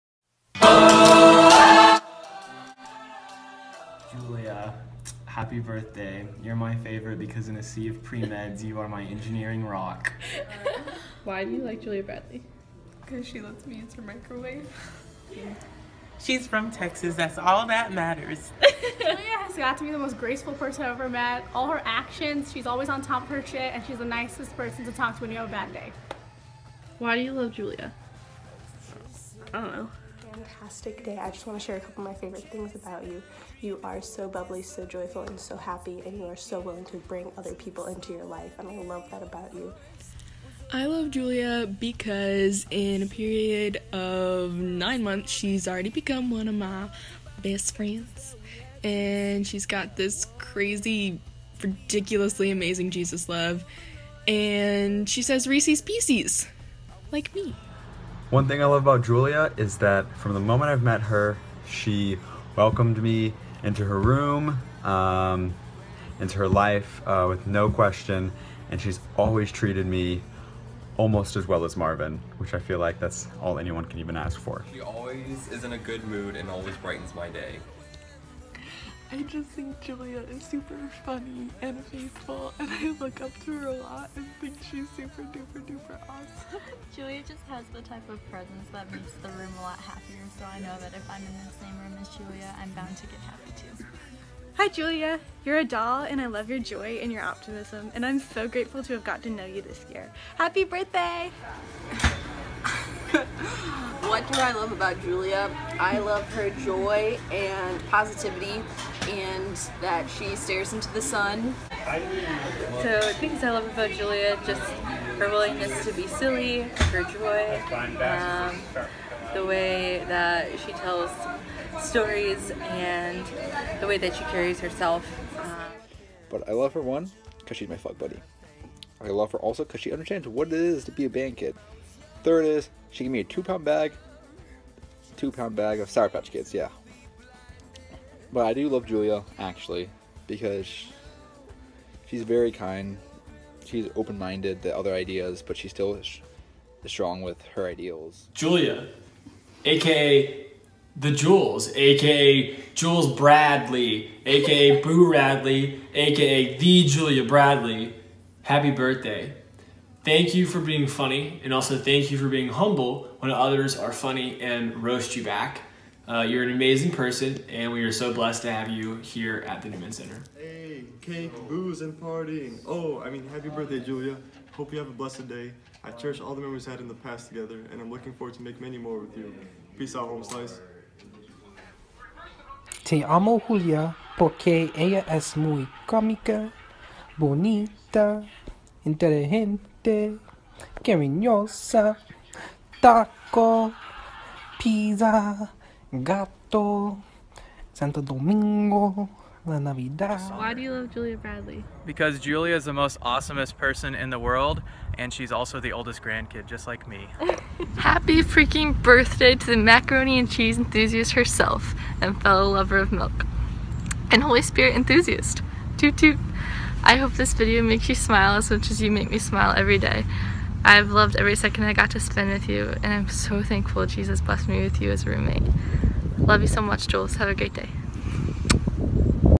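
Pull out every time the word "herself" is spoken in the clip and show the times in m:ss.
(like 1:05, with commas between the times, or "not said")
2:04, 3:31.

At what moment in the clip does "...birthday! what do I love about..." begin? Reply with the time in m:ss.
1:40.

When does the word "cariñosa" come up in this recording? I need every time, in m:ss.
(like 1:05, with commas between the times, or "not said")
3:10.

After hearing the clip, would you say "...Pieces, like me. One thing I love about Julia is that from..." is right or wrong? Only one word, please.
right.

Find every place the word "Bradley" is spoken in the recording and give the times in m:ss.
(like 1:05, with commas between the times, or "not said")
0:12, 2:33, 2:37, 3:21.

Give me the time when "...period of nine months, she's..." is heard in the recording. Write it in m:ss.
0:43.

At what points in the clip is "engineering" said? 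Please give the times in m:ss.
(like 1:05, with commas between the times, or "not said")
0:09.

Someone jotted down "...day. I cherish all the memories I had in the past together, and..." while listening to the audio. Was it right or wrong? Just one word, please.
right.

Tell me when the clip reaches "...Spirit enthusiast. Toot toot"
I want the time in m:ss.
3:34.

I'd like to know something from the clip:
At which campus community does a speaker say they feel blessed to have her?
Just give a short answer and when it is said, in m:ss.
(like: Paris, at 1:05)
Newman Center, at 2:49.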